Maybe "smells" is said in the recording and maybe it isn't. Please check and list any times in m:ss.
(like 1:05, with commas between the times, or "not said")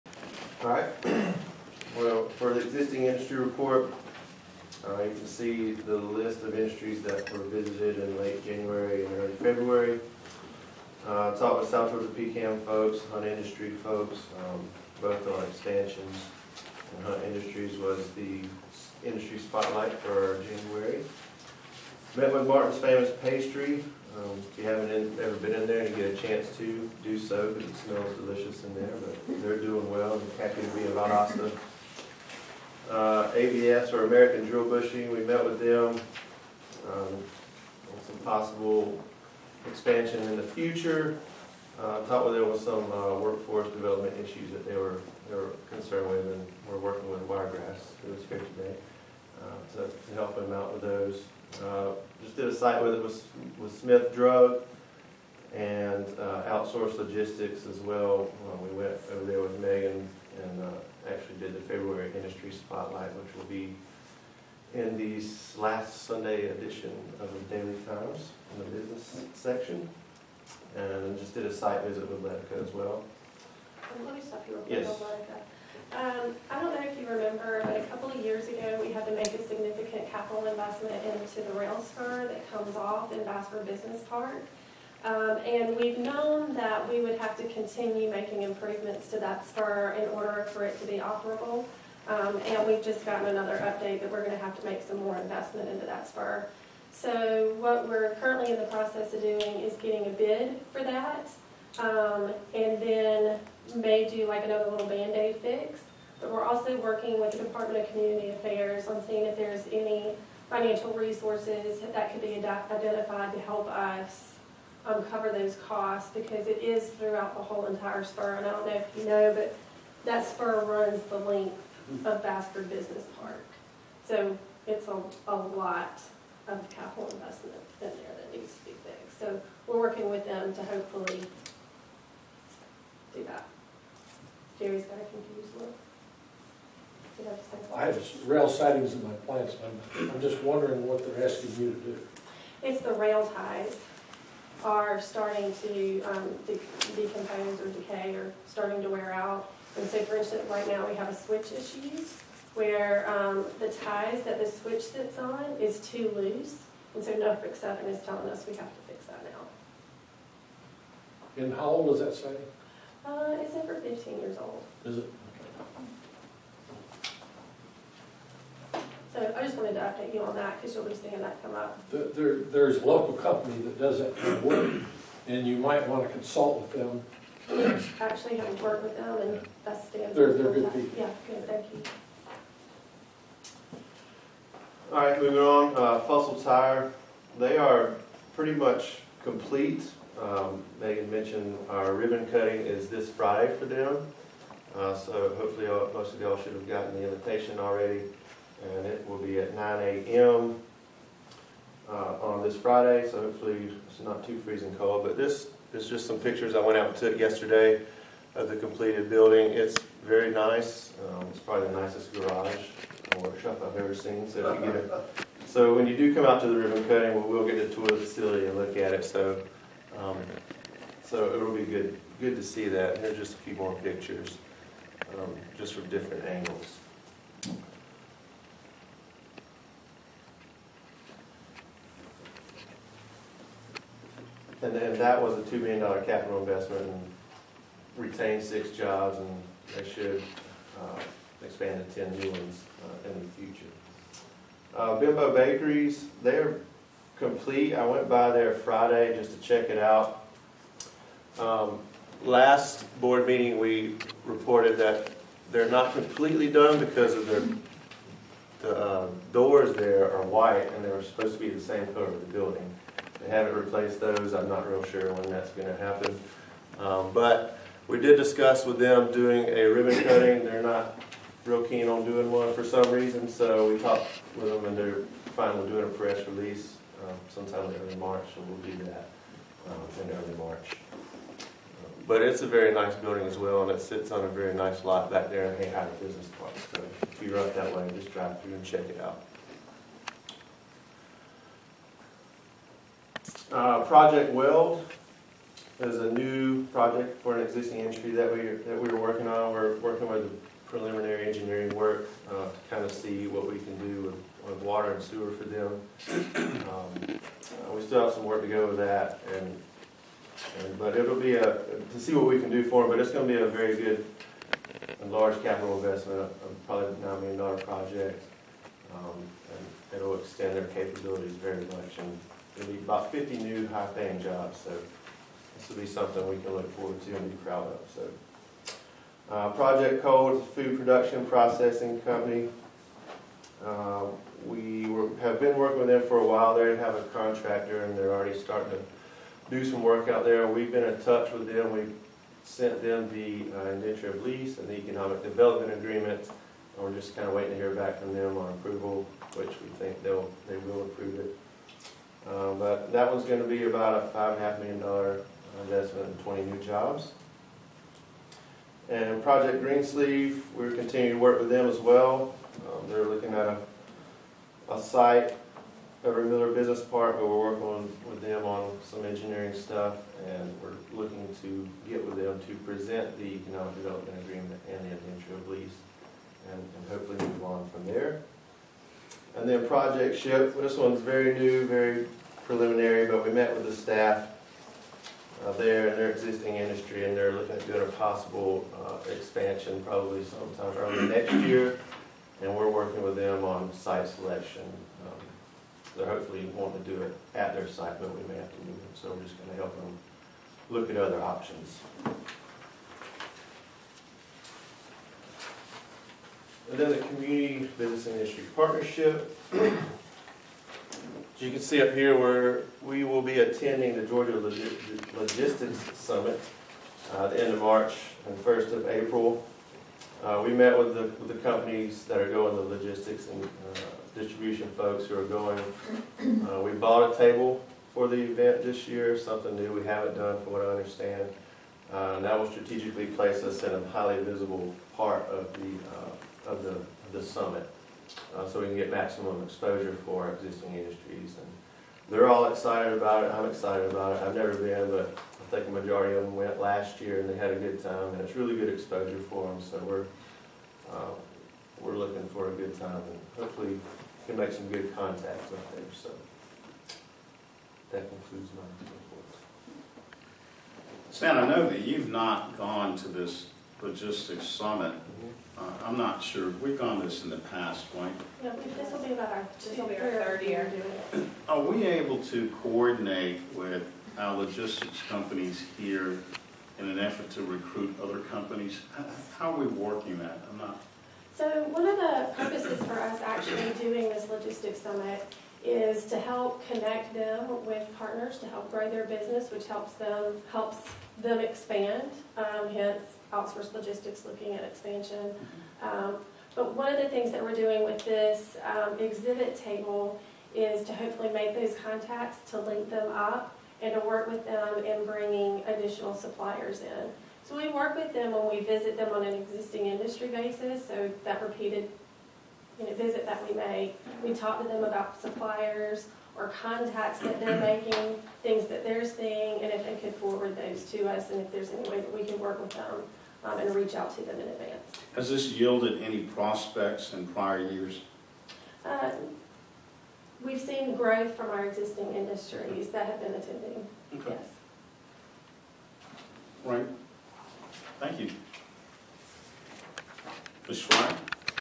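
0:27.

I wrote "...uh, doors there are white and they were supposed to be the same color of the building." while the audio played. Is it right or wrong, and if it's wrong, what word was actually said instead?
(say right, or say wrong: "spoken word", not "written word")
right.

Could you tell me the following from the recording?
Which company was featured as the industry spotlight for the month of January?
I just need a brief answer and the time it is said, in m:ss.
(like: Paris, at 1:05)
Hunt Industries, at 0:17.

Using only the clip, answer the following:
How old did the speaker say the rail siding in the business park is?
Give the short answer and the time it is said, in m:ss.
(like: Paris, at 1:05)
over 15 years, at 2:43.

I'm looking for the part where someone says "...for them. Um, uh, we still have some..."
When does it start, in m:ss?
5:05.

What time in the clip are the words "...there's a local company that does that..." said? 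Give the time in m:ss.
2:52.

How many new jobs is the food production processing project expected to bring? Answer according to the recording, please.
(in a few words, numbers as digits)
20.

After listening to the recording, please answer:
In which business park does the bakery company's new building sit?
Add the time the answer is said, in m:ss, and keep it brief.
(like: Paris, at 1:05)
Hay Hyder Business Park, at 4:45.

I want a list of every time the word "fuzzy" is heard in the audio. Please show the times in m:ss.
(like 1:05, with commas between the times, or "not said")
not said.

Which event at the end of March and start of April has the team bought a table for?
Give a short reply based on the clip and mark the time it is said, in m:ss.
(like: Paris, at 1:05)
Georgia Logistics Summit, at 6:54.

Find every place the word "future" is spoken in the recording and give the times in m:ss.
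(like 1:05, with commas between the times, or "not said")
0:40, 4:03.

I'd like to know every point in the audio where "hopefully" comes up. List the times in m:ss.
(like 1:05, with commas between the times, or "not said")
2:10, 3:15, 3:23, 6:16, 6:36, 7:33, 8:20.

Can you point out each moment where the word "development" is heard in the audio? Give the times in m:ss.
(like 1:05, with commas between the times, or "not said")
0:43, 5:45, 6:13.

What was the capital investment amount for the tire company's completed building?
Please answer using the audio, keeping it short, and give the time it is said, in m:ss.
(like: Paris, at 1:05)
$2 million, at 3:55.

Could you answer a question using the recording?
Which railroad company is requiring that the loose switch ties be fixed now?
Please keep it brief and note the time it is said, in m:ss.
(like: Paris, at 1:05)
Norfolk Southern, at 2:37.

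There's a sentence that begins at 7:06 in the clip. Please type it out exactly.
Uh, we bought a table for the event this year, something new we haven't done from what I understand.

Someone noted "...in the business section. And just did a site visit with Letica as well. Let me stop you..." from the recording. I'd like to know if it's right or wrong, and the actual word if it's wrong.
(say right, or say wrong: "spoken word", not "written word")
right.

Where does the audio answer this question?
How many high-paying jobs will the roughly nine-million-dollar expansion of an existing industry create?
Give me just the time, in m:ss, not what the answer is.
5:23.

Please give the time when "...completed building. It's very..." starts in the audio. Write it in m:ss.
3:28.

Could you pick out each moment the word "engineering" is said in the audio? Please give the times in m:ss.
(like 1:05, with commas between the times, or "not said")
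5:01, 6:09.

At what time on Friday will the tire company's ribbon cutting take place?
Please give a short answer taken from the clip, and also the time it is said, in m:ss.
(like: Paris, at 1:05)
9 a.m., at 3:19.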